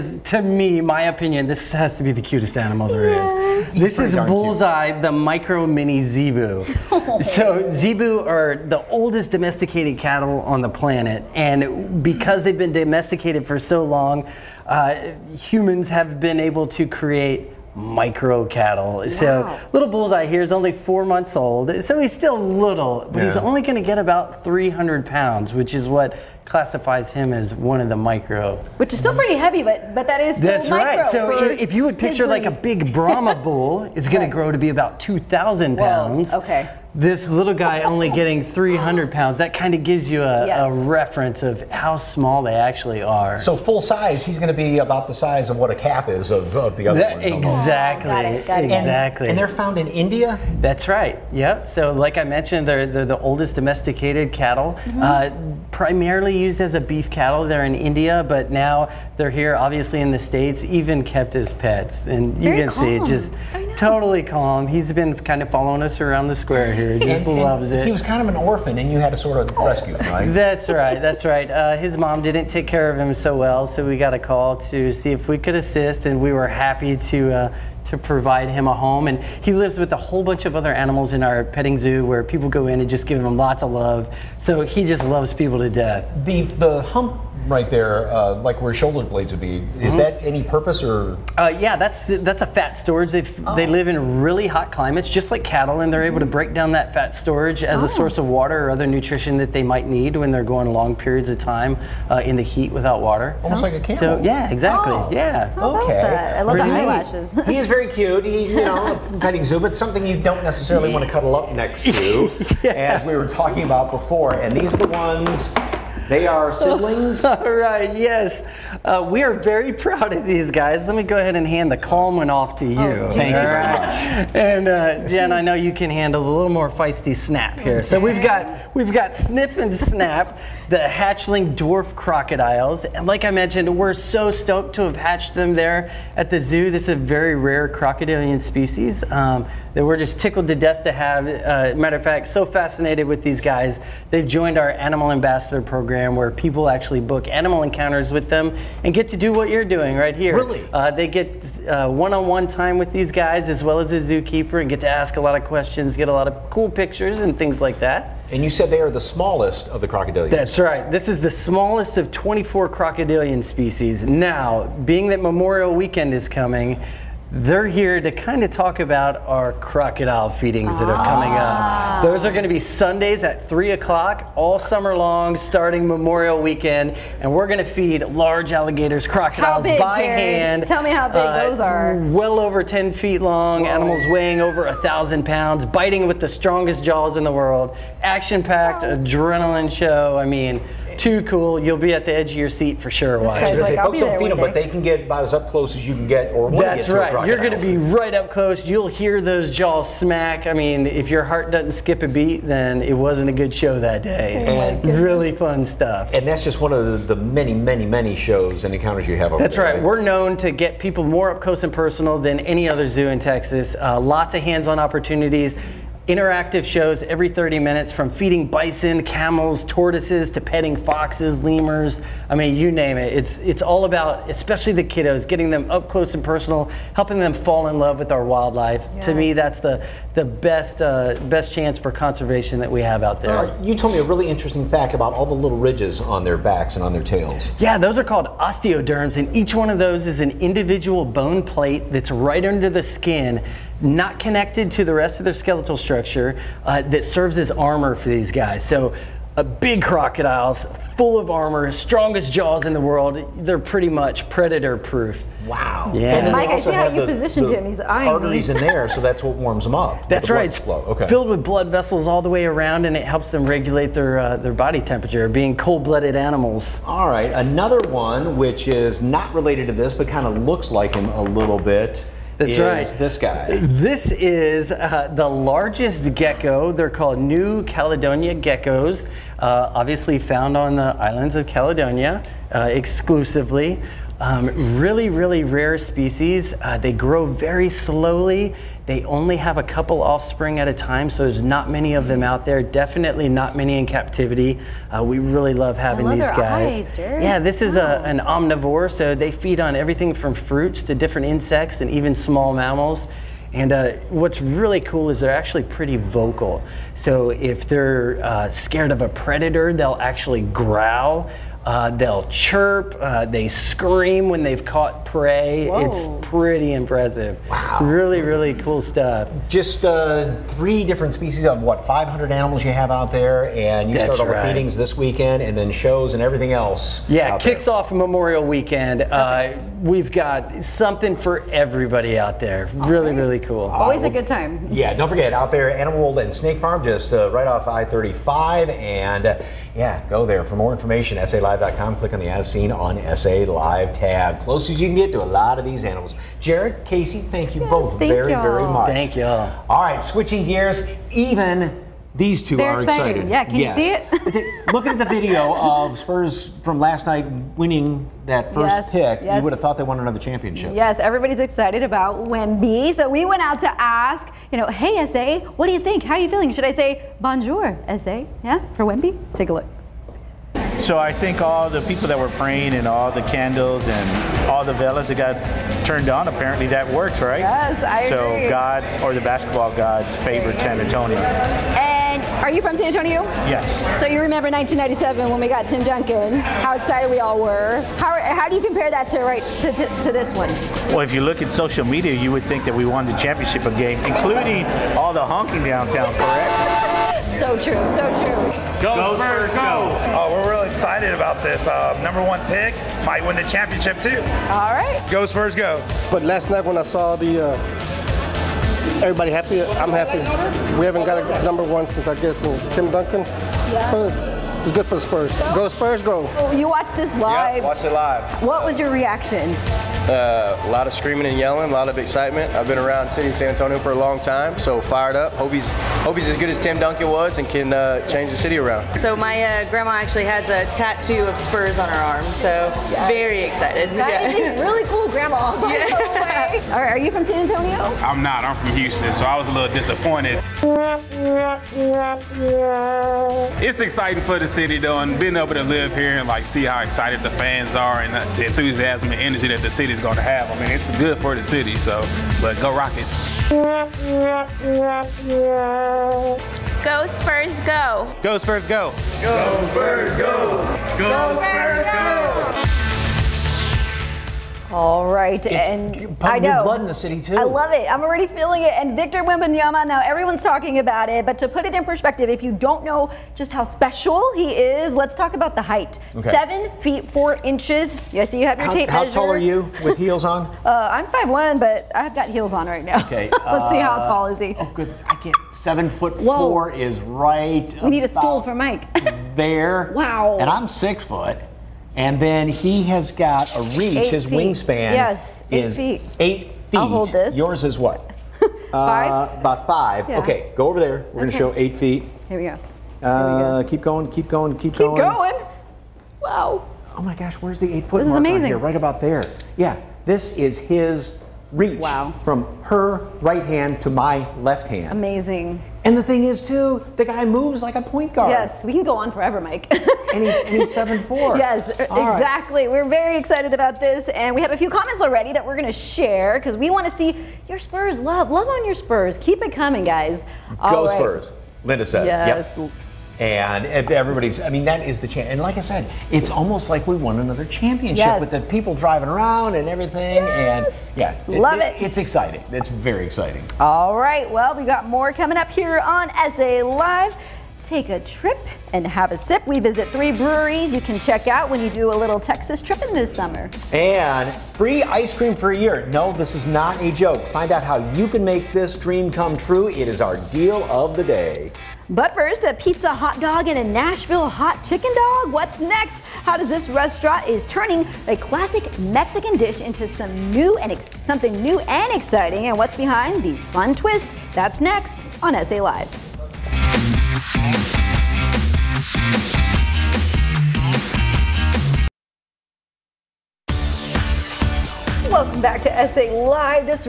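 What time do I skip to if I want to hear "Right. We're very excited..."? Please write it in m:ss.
8:42.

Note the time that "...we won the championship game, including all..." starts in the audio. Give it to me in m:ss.
6:32.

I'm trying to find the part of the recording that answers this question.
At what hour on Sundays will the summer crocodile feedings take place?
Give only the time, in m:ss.
2:53.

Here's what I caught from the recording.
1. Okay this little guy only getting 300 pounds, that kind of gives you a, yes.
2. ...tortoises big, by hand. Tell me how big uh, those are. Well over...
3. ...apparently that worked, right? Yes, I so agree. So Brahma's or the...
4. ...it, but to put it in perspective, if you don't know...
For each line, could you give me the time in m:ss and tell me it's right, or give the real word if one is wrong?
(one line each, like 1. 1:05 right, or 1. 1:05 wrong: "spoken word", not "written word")
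1. 0:36 right
2. 2:59 wrong: "crocodiles", not "tortoises"
3. 6:16 wrong: "God", not "Brahma"
4. 7:51 right.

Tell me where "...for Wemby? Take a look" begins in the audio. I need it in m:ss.
6:08.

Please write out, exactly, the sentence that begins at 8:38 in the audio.
Yes, we can go on forever, Mike.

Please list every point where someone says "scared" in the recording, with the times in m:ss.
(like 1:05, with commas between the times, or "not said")
5:08.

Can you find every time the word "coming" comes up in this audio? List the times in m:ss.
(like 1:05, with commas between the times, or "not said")
2:46, 2:51, 8:49, 9:05.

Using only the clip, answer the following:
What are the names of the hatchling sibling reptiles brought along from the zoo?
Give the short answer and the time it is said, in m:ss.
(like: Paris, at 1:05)
Snip and Snap, at 2:09.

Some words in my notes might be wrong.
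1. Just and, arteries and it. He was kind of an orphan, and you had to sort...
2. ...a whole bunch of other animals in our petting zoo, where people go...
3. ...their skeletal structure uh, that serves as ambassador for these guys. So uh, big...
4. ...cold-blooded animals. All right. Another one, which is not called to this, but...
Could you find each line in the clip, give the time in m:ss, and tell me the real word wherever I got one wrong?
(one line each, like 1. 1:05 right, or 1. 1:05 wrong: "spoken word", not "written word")
1. 1:06 wrong: "loves", not "arteries"
2. 1:19 right
3. 4:05 wrong: "armor", not "ambassador"
4. 4:25 wrong: "related", not "called".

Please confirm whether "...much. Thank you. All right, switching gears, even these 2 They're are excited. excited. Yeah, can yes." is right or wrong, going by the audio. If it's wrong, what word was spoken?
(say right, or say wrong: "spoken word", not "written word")
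right.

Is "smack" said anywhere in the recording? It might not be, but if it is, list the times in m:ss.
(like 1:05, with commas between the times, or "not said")
3:19.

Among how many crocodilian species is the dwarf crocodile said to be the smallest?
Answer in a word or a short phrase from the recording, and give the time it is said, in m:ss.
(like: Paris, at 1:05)
24, at 2:42.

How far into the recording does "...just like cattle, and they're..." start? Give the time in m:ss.
1:35.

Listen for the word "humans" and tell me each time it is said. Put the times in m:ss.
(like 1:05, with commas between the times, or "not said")
0:15.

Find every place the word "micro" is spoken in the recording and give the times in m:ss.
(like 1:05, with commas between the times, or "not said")
0:05, 0:17, 0:27.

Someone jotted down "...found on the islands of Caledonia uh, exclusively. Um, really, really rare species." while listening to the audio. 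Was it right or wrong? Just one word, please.
right.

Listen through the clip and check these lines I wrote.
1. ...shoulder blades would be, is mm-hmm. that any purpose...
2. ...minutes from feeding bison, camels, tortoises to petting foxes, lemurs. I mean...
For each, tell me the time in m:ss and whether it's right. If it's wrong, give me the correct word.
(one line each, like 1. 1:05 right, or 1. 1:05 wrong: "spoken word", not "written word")
1. 1:28 right
2. 3:37 right.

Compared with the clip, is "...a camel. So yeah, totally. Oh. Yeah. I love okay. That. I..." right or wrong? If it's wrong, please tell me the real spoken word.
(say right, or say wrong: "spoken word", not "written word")
wrong: "exactly", not "totally".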